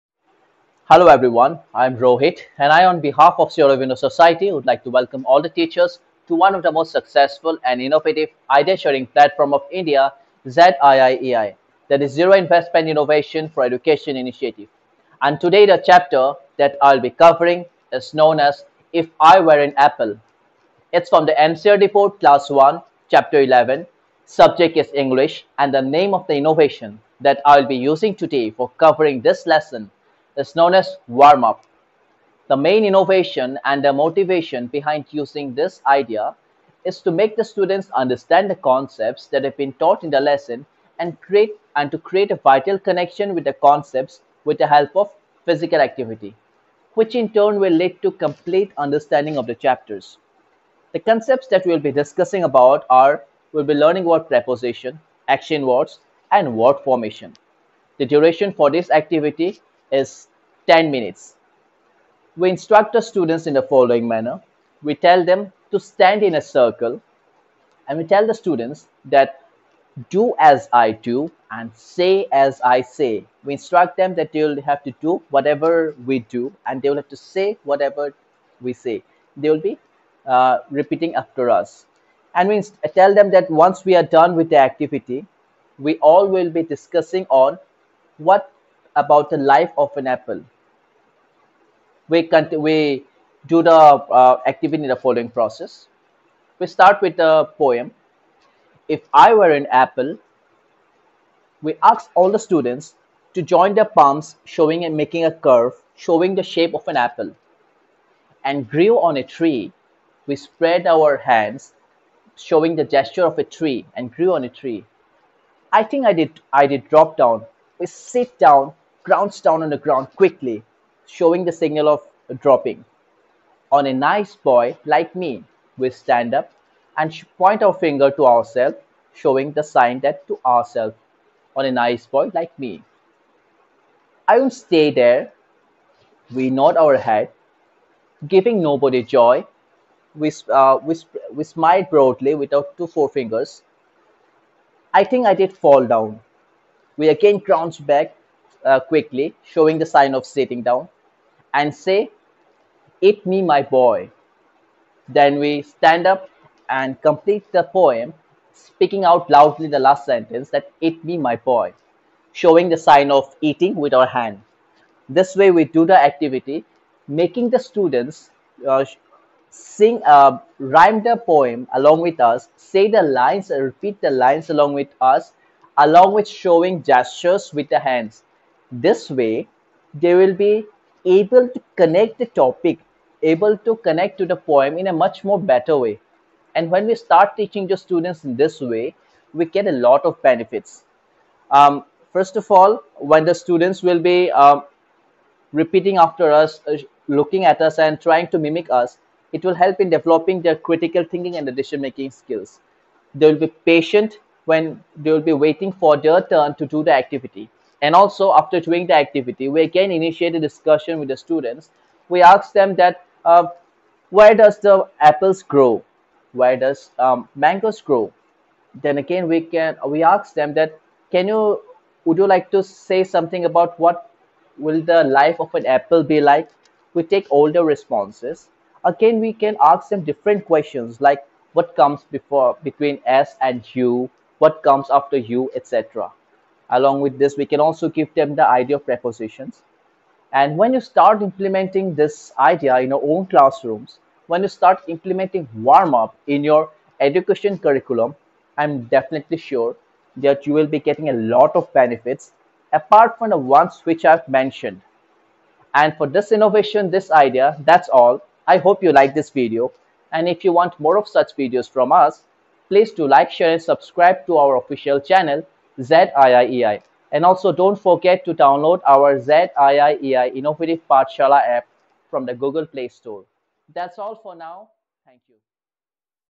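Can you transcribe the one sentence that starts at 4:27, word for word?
And also don't forget to download our ZIIEI Innovative Pathshaala app from the Google Play Store.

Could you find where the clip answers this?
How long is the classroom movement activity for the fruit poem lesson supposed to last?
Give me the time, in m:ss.
1:00.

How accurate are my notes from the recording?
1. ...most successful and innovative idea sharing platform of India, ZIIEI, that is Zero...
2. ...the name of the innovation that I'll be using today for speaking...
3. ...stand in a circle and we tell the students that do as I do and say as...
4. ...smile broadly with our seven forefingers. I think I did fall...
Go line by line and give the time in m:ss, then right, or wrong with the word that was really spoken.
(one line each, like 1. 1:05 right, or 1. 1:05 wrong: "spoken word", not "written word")
1. 0:06 right
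2. 0:25 wrong: "covering", not "speaking"
3. 1:05 right
4. 2:21 wrong: "two", not "seven".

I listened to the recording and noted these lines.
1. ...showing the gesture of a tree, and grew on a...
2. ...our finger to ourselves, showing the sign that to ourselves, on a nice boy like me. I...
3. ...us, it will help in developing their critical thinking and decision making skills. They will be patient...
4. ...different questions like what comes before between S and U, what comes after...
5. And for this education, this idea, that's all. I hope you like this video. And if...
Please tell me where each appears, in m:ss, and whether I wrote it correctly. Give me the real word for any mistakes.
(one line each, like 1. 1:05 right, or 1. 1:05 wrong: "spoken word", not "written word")
1. 1:52 right
2. 2:07 right
3. 3:18 right
4. 3:50 right
5. 4:15 wrong: "innovation", not "education".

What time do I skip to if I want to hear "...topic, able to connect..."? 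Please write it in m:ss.
3:02.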